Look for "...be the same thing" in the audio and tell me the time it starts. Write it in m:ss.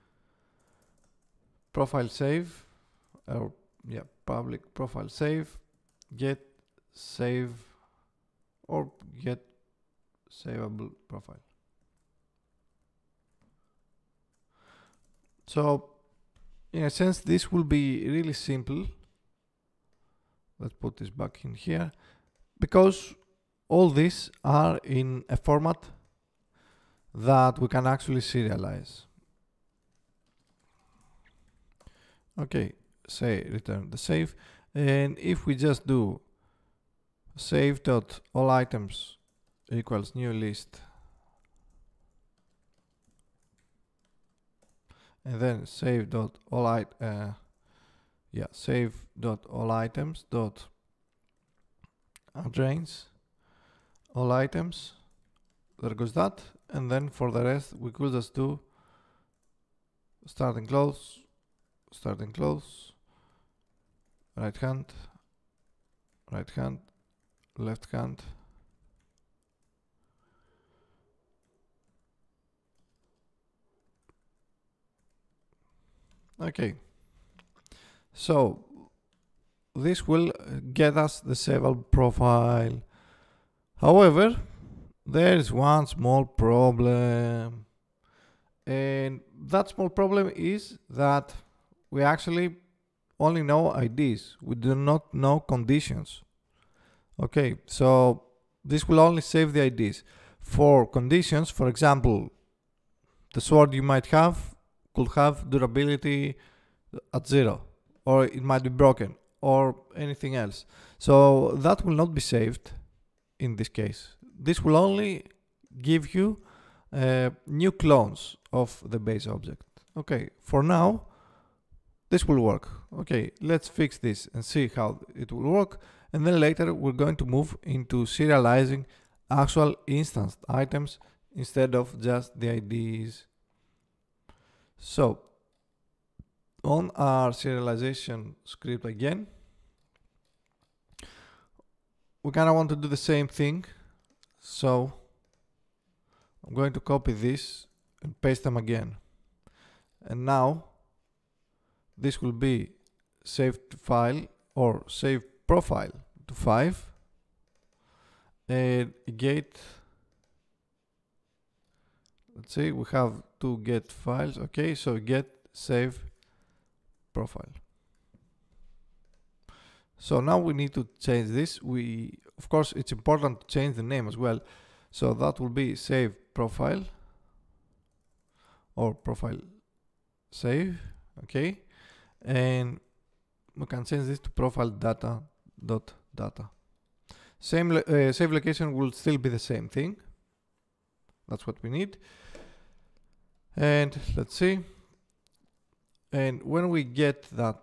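3:09.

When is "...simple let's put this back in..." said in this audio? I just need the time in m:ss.
0:18.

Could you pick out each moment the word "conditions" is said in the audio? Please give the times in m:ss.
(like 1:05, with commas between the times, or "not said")
1:35, 1:40.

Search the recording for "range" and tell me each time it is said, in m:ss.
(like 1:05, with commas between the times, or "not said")
0:52.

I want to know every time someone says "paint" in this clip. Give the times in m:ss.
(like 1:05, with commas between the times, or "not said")
not said.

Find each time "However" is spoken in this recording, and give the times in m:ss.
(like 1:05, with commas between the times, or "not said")
1:23.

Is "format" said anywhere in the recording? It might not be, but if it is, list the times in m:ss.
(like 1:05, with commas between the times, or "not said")
0:25.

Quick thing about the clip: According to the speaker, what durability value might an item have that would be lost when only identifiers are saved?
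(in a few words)
zero.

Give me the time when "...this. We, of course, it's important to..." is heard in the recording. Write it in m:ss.
2:51.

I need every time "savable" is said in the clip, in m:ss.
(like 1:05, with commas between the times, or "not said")
0:10, 1:21.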